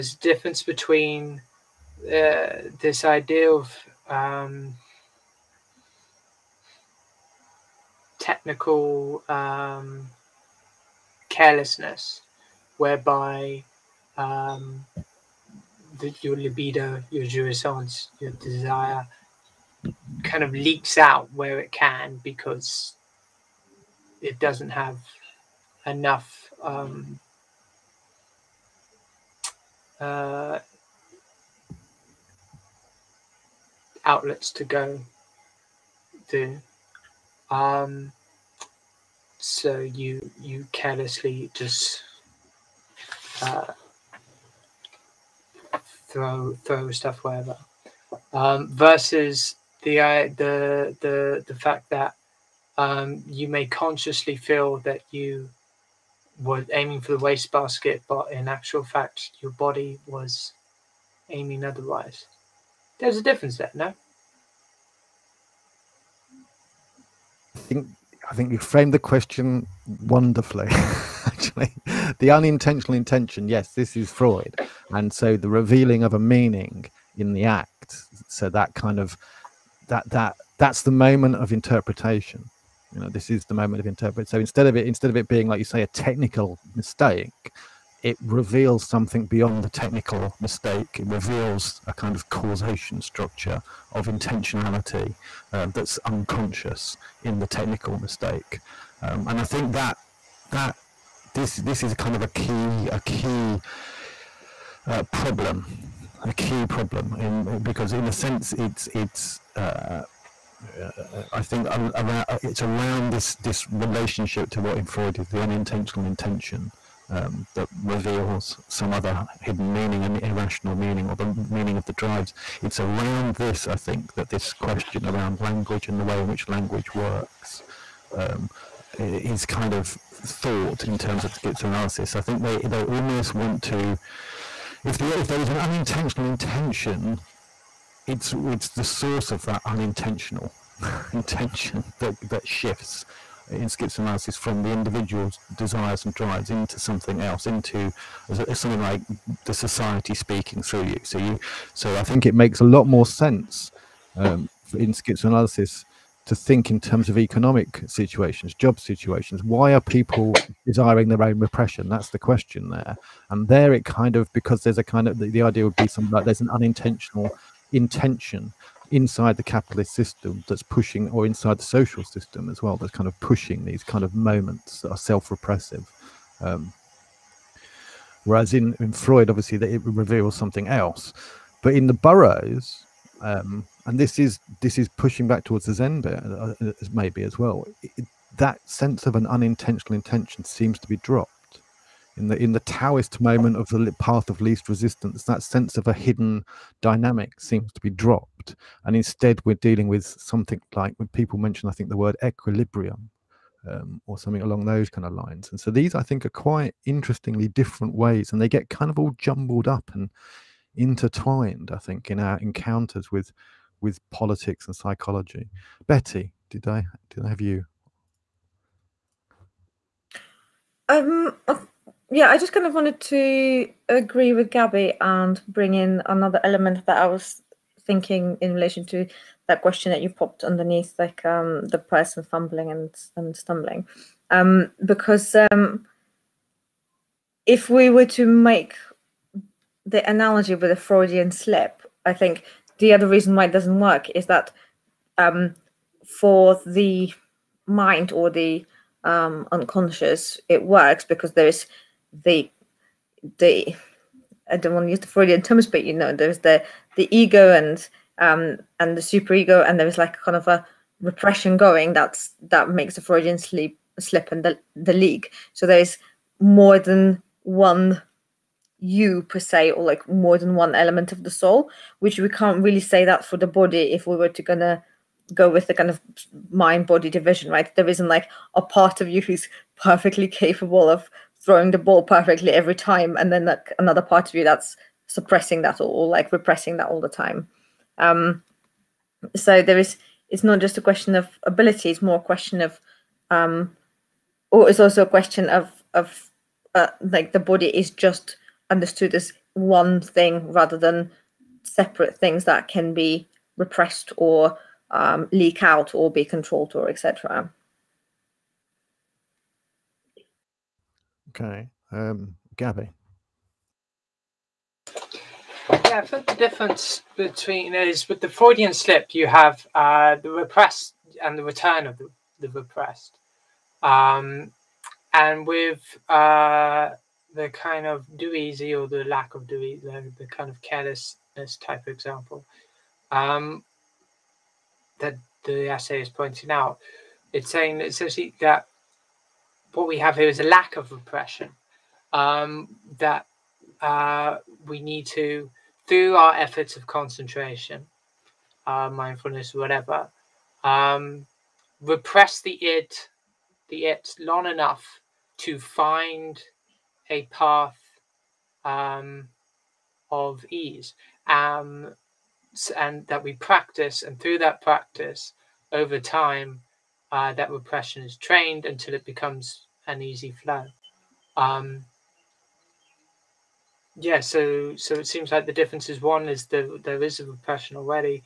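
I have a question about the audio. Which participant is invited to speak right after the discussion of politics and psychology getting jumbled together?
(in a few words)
Betty.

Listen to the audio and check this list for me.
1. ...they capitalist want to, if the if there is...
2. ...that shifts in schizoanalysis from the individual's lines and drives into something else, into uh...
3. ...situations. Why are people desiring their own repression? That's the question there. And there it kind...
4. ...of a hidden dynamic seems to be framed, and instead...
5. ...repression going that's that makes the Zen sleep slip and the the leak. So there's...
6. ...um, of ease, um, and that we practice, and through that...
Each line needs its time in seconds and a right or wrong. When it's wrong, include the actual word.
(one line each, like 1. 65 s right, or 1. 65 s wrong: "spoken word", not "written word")
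1. 132 s wrong: "almost", not "capitalist"
2. 142 s wrong: "desires", not "lines"
3. 158 s right
4. 195 s wrong: "dropped", not "framed"
5. 260 s wrong: "Freudian", not "Zen"
6. 358 s right.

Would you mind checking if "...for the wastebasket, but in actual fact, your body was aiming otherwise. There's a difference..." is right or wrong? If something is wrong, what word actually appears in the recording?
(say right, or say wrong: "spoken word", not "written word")
right.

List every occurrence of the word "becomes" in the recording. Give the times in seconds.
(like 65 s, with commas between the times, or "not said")
369 s.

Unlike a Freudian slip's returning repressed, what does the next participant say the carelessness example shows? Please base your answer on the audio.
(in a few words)
a lack of repression.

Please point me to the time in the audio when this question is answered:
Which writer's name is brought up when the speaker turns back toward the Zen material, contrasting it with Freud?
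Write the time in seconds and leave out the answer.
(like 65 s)
181 s.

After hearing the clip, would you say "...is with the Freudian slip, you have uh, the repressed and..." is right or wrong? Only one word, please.
right.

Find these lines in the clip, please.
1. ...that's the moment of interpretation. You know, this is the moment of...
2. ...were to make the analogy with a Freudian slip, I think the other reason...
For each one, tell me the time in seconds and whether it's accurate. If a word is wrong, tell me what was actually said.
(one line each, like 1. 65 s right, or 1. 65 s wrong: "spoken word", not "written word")
1. 80 s right
2. 237 s right.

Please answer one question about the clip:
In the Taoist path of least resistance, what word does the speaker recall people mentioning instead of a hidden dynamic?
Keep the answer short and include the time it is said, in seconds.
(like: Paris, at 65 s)
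equilibrium, at 202 s.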